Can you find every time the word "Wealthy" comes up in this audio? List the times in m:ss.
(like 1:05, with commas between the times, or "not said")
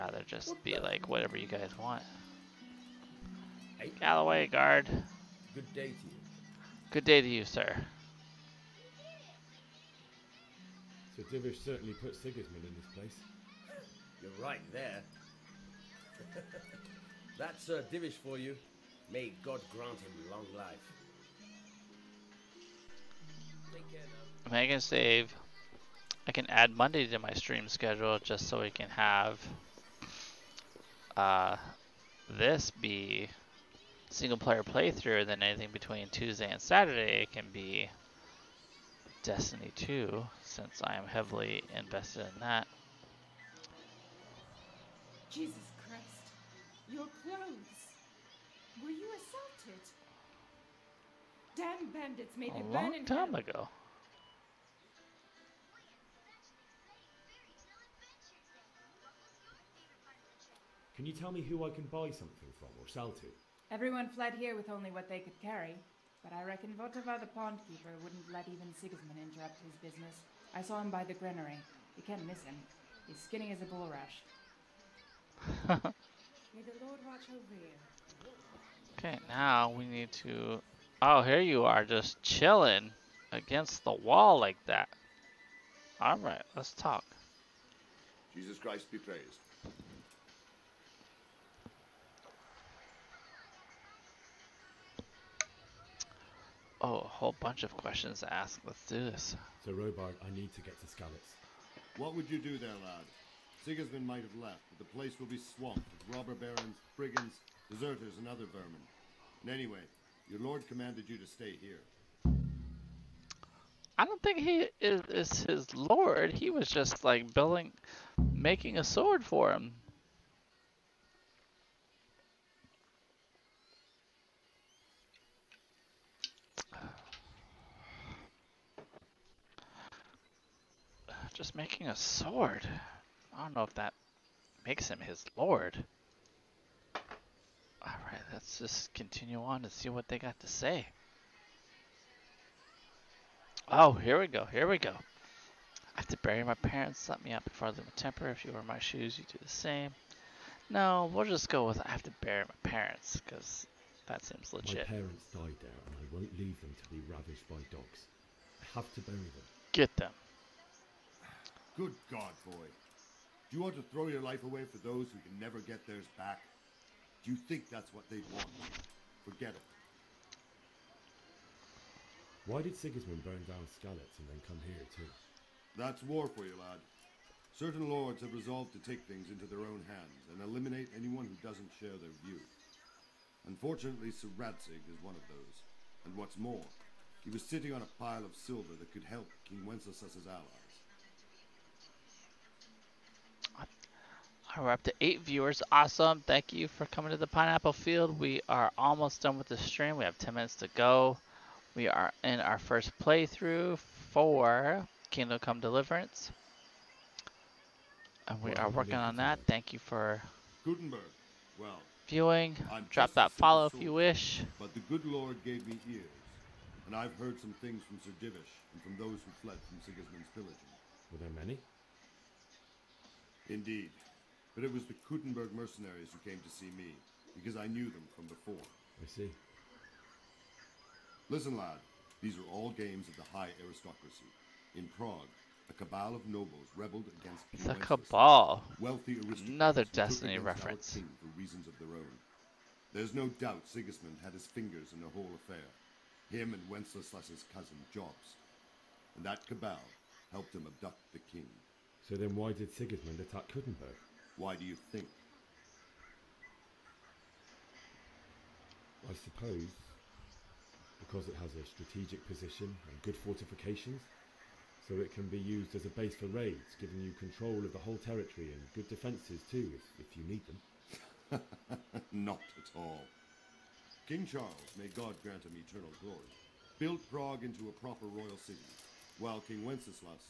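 3:58.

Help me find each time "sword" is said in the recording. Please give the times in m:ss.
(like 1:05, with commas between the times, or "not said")
1:58, 2:11.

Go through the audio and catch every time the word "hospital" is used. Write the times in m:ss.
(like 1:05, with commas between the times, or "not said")
not said.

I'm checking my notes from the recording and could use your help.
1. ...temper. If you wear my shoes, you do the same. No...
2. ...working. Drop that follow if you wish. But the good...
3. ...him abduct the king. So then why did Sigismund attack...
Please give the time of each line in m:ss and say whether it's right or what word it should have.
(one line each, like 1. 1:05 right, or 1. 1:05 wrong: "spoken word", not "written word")
1. 2:27 right
2. 3:32 wrong: "viewing", not "working"
3. 4:10 right.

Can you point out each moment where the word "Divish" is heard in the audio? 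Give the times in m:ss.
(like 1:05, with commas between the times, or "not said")
0:11, 0:17, 3:38.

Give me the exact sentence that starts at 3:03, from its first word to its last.
Unfortunately, Sir Radzig is one of those.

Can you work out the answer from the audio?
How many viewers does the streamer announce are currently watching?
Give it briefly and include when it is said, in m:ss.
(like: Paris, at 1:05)
8, at 3:15.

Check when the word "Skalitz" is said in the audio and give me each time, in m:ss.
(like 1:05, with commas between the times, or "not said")
1:40, 2:53.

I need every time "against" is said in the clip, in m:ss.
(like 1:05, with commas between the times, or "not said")
1:23, 3:57.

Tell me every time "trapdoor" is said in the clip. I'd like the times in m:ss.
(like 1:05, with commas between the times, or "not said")
not said.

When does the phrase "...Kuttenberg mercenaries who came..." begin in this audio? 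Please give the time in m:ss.
3:45.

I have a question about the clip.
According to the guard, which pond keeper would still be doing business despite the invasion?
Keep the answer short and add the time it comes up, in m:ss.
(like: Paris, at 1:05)
Votava, at 1:06.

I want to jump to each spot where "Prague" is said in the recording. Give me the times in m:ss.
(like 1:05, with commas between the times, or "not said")
3:54, 4:37.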